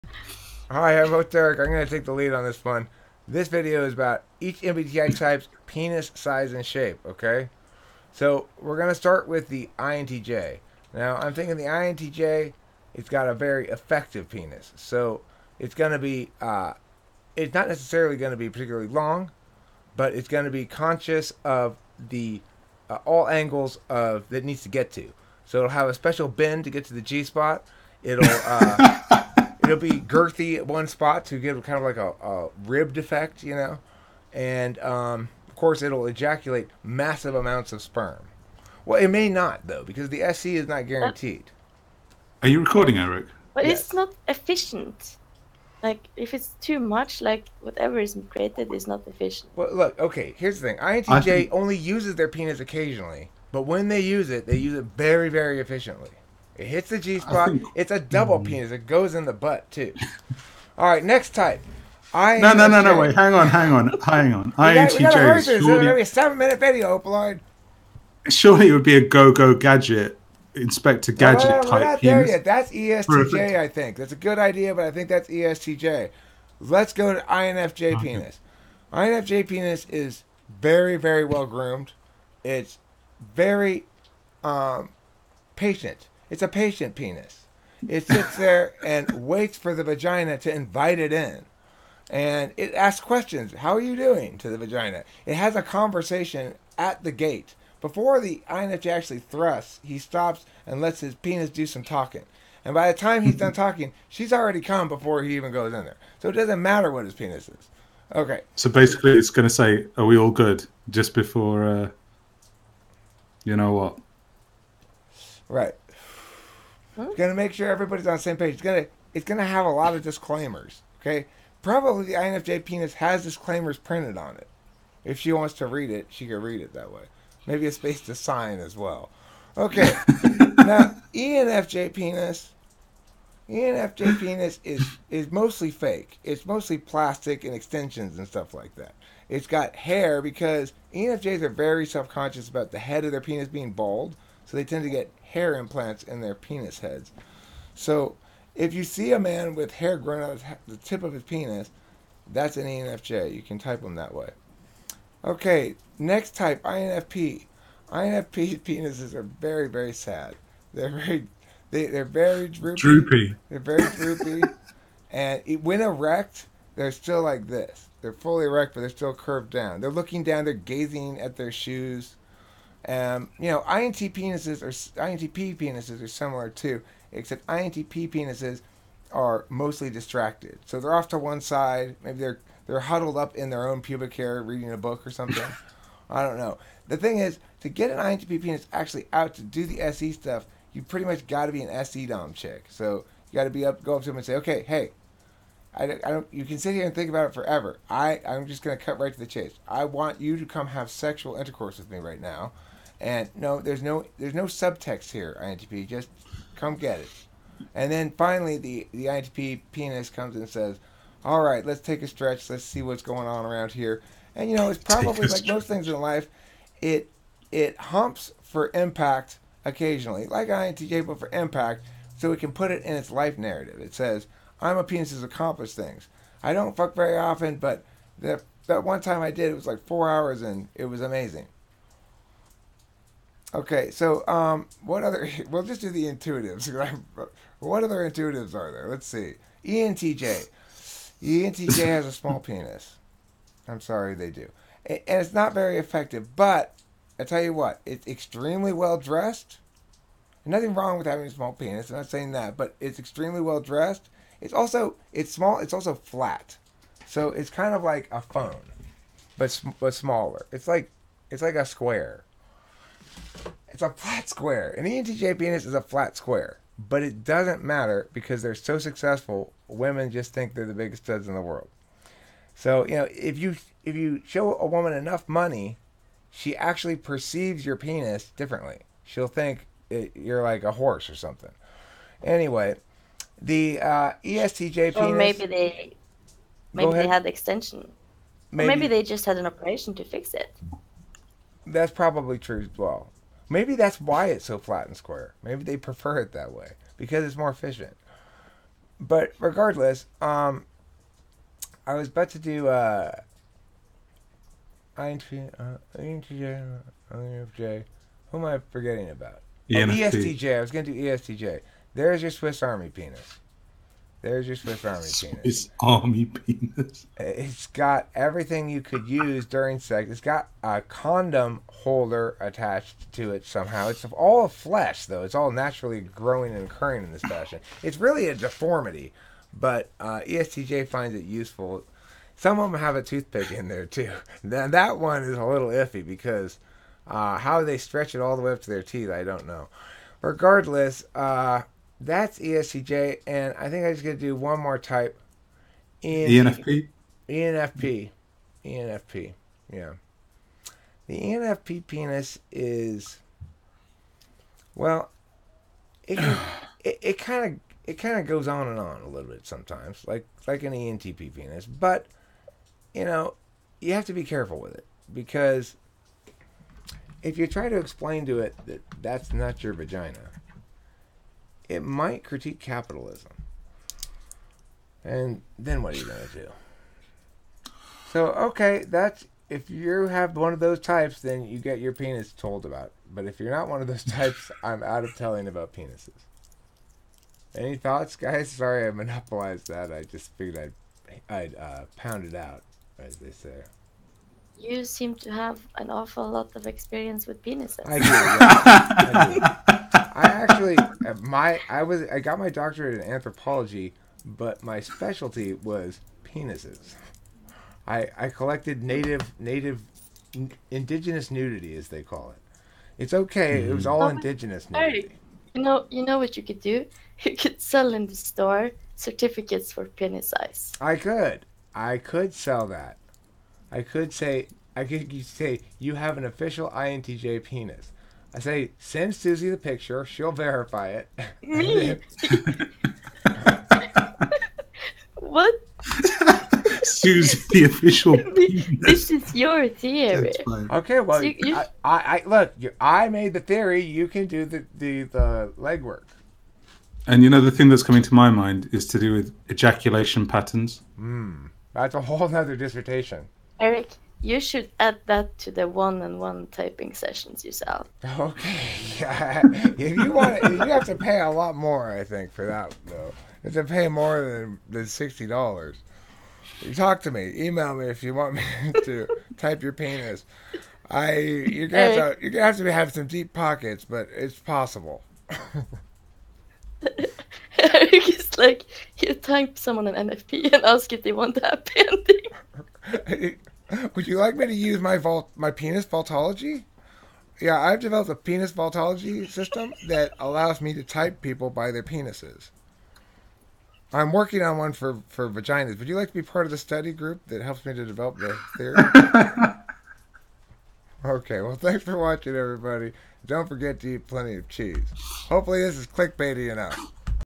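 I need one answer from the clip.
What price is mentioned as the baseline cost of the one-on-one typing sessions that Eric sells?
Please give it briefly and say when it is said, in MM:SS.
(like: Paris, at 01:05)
$60, at 07:44.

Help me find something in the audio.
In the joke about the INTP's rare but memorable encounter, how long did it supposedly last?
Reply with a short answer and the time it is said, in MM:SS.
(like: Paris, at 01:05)
4 hours, at 03:49.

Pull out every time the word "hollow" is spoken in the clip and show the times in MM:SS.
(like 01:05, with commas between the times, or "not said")
not said.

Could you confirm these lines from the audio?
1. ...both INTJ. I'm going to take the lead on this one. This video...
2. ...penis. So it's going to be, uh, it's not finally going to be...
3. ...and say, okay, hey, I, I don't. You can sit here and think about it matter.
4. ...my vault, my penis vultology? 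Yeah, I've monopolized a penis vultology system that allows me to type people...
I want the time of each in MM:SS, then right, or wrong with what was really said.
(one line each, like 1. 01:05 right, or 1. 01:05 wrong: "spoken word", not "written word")
1. 00:01 wrong: "Derek", not "INTJ"
2. 00:14 wrong: "necessarily", not "finally"
3. 03:14 wrong: "forever", not "matter"
4. 08:04 wrong: "developed", not "monopolized".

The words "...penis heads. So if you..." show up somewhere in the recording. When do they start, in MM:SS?
02:26.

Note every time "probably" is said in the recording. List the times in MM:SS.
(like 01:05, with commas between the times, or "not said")
02:01, 03:34, 04:51.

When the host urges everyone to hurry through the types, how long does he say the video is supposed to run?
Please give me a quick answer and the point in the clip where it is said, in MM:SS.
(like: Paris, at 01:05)
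7 minutes, at 01:06.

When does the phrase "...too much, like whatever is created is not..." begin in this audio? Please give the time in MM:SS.
00:46.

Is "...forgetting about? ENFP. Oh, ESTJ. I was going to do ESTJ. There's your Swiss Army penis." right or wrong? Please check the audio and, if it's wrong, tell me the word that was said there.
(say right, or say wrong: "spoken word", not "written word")
right.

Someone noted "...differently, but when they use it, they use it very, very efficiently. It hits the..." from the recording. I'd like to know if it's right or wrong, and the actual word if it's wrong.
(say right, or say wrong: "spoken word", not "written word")
wrong: "occasionally", not "differently".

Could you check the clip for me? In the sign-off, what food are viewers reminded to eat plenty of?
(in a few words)
Cheese.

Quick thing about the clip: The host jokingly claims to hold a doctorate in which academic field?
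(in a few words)
Anthropology.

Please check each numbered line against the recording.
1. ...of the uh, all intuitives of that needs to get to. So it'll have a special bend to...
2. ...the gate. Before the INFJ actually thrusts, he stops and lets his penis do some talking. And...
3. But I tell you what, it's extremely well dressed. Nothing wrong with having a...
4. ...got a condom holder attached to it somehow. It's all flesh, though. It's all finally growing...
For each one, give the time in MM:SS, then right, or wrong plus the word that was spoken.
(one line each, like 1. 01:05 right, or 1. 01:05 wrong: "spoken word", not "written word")
1. 00:21 wrong: "angles", not "intuitives"
2. 01:37 right
3. 04:06 right
4. 05:20 wrong: "naturally", not "finally".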